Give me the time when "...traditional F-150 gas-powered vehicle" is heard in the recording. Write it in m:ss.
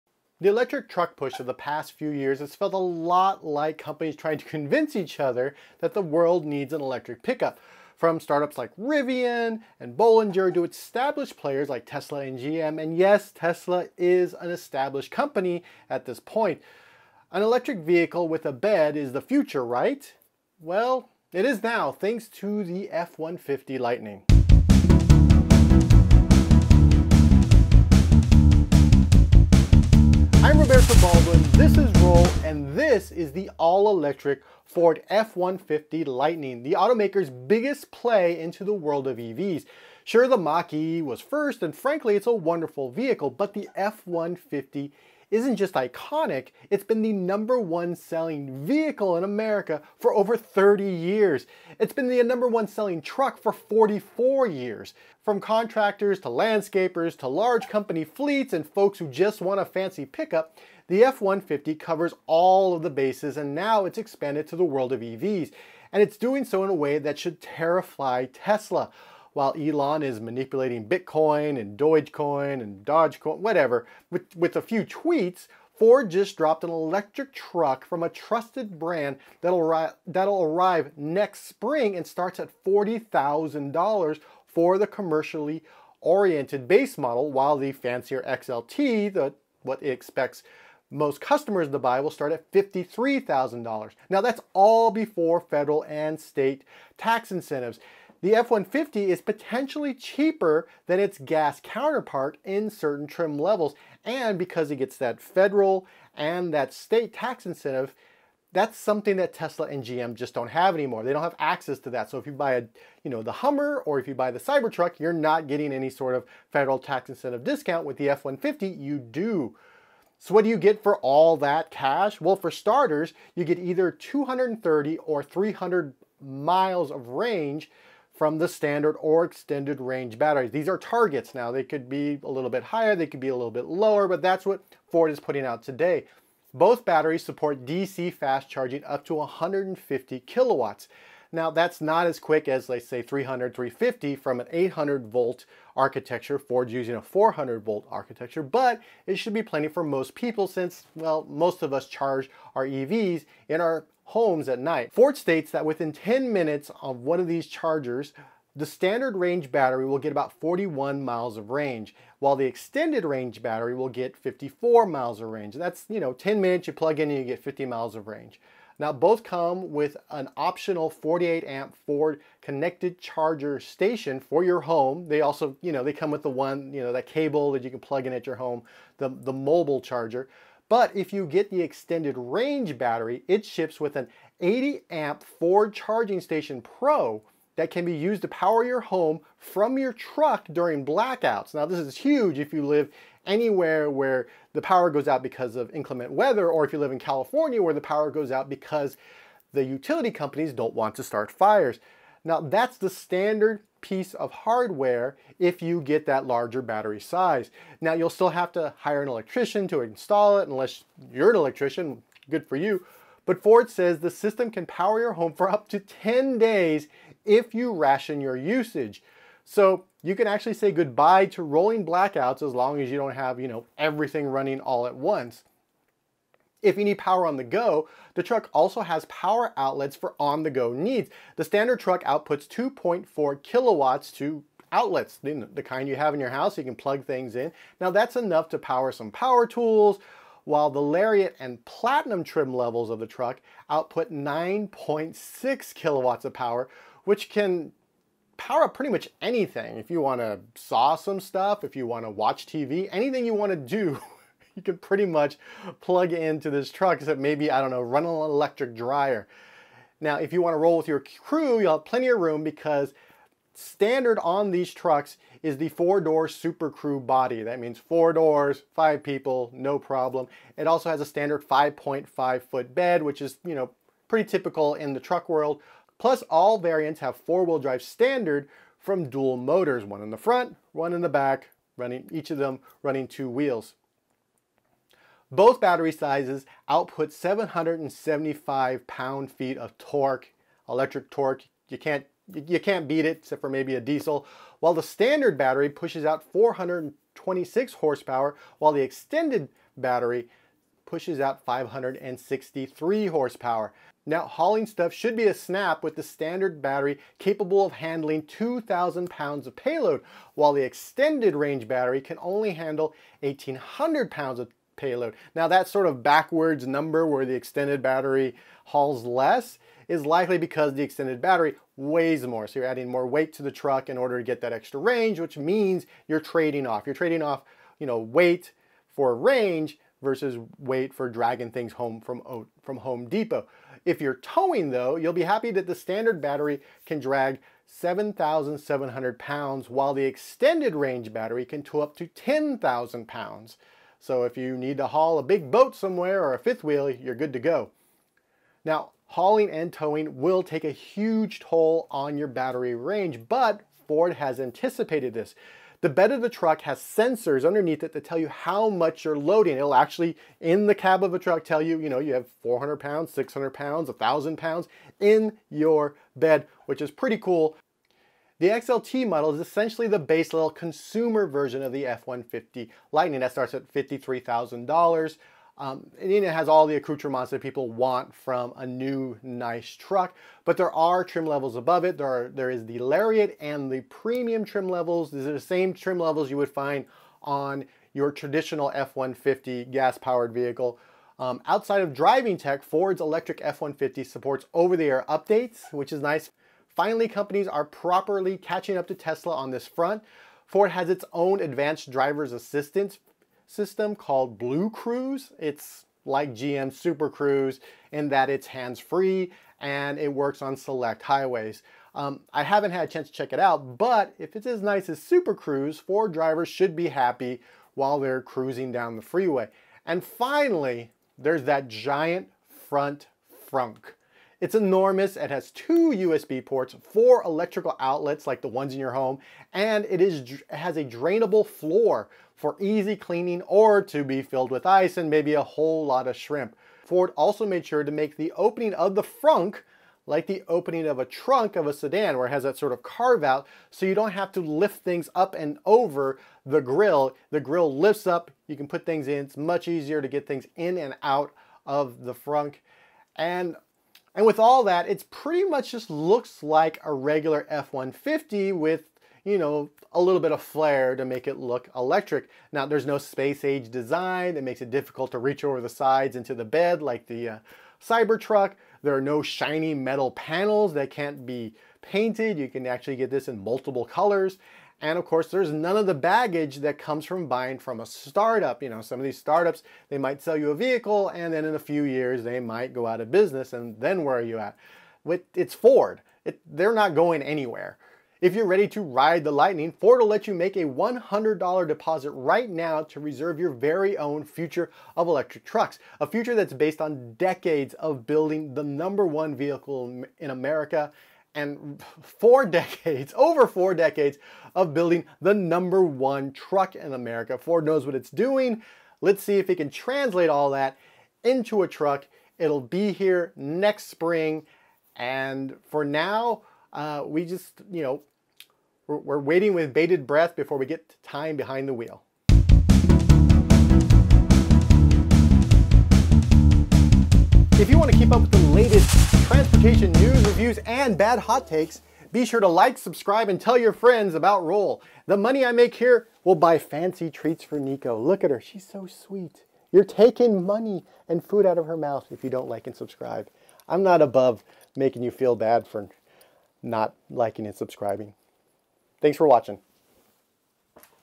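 6:28.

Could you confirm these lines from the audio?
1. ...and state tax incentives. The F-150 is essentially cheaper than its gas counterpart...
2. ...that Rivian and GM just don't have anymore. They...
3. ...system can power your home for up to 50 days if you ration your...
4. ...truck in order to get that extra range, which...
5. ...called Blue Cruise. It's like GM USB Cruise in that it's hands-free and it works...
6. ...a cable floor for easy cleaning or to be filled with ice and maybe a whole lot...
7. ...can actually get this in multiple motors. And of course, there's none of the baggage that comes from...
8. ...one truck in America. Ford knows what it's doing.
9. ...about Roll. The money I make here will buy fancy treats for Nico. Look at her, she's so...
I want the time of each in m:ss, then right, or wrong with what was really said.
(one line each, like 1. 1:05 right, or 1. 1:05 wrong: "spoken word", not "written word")
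1. 1:35 wrong: "potentially", not "essentially"
2. 1:49 wrong: "Tesla", not "Rivian"
3. 3:34 wrong: "10", not "50"
4. 5:23 right
5. 6:43 wrong: "Super", not "USB"
6. 7:10 wrong: "drainable", not "cable"
7. 7:52 wrong: "colors", not "motors"
8. 8:25 right
9. 8:54 right.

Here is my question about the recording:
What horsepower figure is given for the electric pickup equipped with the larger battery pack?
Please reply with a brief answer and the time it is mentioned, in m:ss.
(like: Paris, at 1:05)
563, at 5:01.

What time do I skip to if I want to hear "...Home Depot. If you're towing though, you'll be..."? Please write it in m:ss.
5:32.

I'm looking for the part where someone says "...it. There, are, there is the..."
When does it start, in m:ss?
6:21.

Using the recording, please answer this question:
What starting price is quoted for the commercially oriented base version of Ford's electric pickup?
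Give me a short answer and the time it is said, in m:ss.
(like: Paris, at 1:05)
$40,000, at 1:22.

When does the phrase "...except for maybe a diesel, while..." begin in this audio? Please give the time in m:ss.
4:53.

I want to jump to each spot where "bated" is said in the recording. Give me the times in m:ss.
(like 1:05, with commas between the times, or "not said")
8:39.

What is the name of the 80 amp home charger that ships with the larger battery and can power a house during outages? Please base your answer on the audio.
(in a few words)
Ford Charging Station Pro.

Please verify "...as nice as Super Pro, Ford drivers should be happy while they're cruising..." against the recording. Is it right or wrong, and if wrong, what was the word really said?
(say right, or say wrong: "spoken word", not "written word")
wrong: "Cruise", not "Pro".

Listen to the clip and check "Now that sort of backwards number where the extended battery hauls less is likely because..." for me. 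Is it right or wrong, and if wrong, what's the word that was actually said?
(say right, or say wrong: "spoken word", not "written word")
right.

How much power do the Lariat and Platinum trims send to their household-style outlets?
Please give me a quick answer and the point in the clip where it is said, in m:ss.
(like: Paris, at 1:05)
9.6 kilowatts, at 4:04.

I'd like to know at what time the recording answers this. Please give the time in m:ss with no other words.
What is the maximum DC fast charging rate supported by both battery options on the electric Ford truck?
2:19.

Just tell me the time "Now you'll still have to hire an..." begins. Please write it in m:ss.
3:27.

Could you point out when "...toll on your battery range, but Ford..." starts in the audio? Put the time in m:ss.
5:51.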